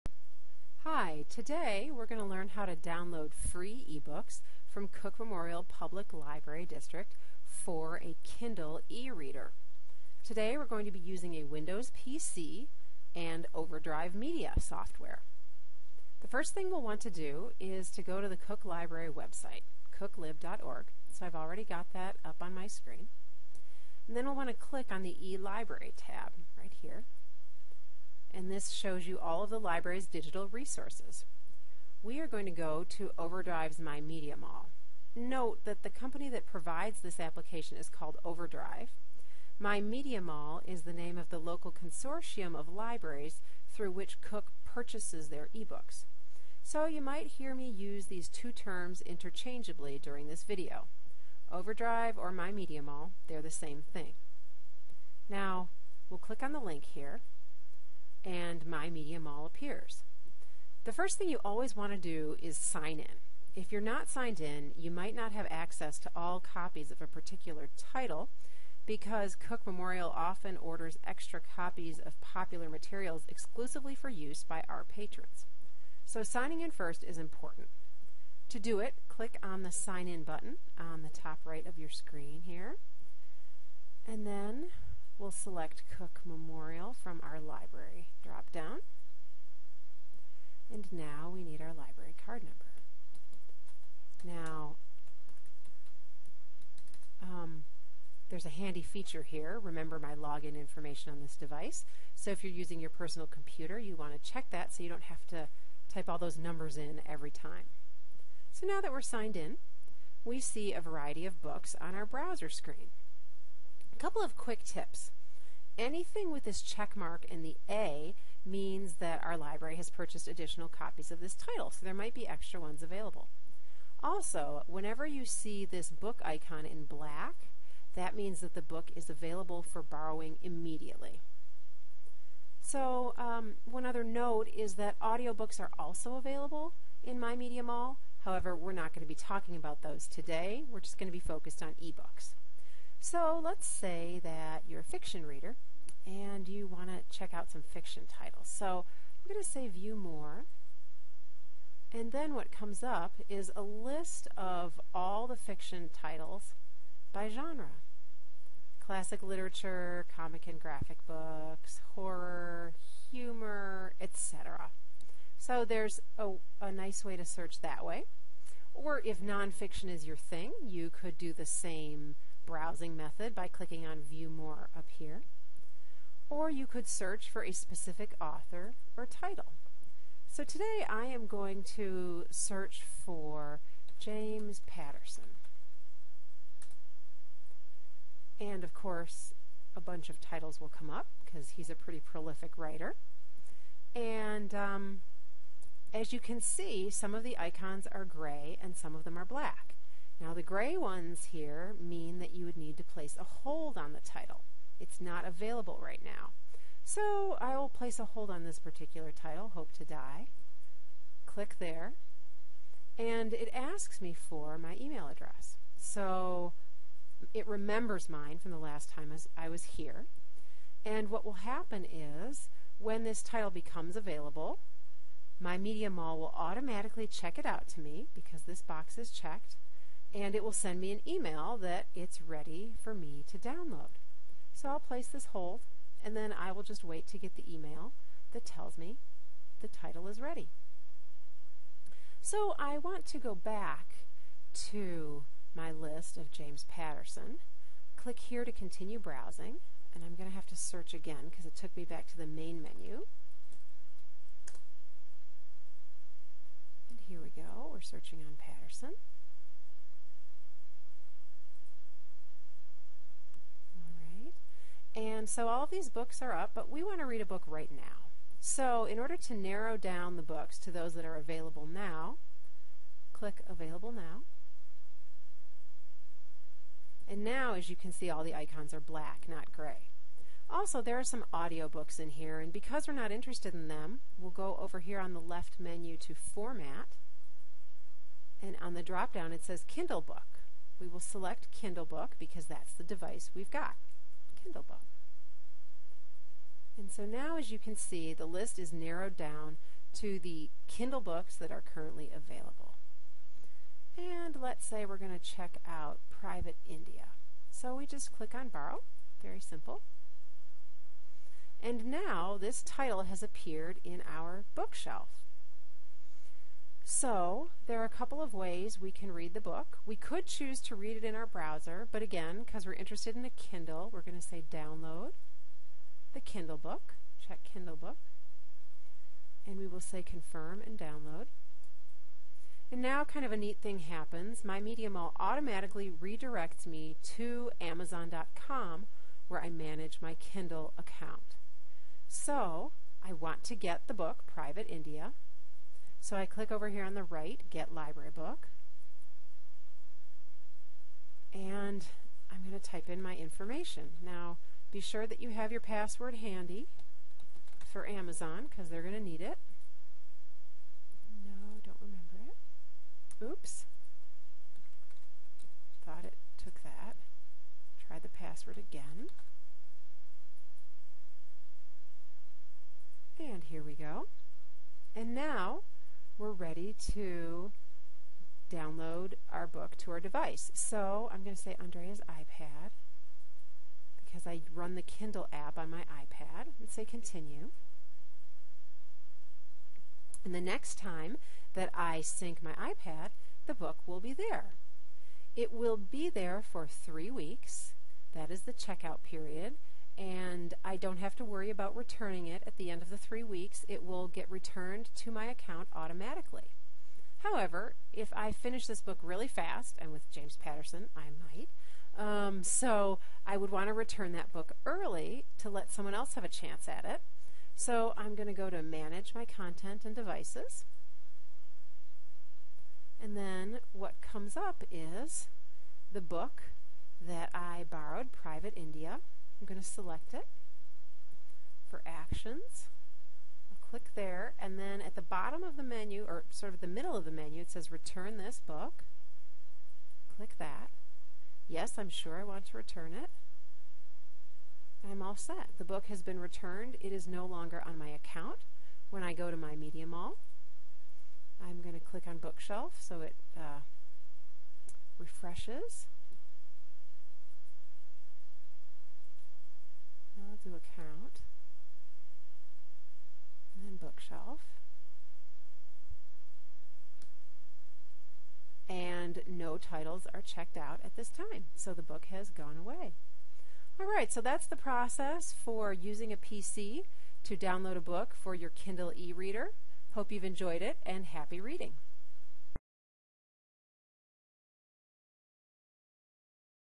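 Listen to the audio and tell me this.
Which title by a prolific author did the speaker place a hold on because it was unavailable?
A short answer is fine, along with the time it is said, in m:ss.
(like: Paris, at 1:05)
Hope to Die, at 3:29.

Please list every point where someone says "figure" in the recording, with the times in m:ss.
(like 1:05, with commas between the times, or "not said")
not said.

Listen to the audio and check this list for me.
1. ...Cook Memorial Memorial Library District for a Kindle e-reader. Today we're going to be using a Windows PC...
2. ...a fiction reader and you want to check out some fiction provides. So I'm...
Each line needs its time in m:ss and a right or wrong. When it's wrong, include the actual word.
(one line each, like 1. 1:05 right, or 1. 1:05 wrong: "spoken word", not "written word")
1. 0:04 wrong: "Public", not "Memorial"
2. 2:24 wrong: "titles", not "provides".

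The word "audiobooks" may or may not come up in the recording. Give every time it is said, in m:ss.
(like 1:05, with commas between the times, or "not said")
2:14, 4:41.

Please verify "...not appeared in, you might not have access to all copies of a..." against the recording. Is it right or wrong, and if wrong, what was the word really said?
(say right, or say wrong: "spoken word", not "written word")
wrong: "signed", not "appeared".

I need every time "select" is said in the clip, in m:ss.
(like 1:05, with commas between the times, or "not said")
1:25, 4:50, 7:09.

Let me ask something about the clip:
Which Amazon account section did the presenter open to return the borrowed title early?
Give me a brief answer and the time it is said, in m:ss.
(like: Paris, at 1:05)
Manage My Content and Devices, at 6:58.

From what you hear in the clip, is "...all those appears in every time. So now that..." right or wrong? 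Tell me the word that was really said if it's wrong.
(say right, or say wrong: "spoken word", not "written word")
wrong: "numbers", not "appears".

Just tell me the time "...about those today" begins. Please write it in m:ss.
2:19.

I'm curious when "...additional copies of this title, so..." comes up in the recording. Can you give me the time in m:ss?
2:00.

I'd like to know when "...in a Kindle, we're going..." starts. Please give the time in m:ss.
5:23.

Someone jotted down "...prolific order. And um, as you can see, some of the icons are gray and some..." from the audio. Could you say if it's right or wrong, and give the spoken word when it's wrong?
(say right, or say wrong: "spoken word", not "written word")
wrong: "writer", not "order".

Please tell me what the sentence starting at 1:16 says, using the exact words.
So signing in first is important.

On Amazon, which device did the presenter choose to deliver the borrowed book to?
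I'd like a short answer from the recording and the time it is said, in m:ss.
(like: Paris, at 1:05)
Andrea's iPad, at 6:21.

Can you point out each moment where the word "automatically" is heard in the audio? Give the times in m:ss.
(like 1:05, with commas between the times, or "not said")
3:46, 5:35, 6:45.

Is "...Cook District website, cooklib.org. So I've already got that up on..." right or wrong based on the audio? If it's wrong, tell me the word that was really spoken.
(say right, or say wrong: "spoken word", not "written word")
wrong: "Library", not "District".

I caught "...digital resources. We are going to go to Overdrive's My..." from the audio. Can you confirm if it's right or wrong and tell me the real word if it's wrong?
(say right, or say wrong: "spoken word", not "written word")
right.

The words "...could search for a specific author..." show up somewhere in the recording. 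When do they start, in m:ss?
2:56.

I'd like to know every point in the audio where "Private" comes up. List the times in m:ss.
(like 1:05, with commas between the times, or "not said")
5:06, 5:44, 7:08.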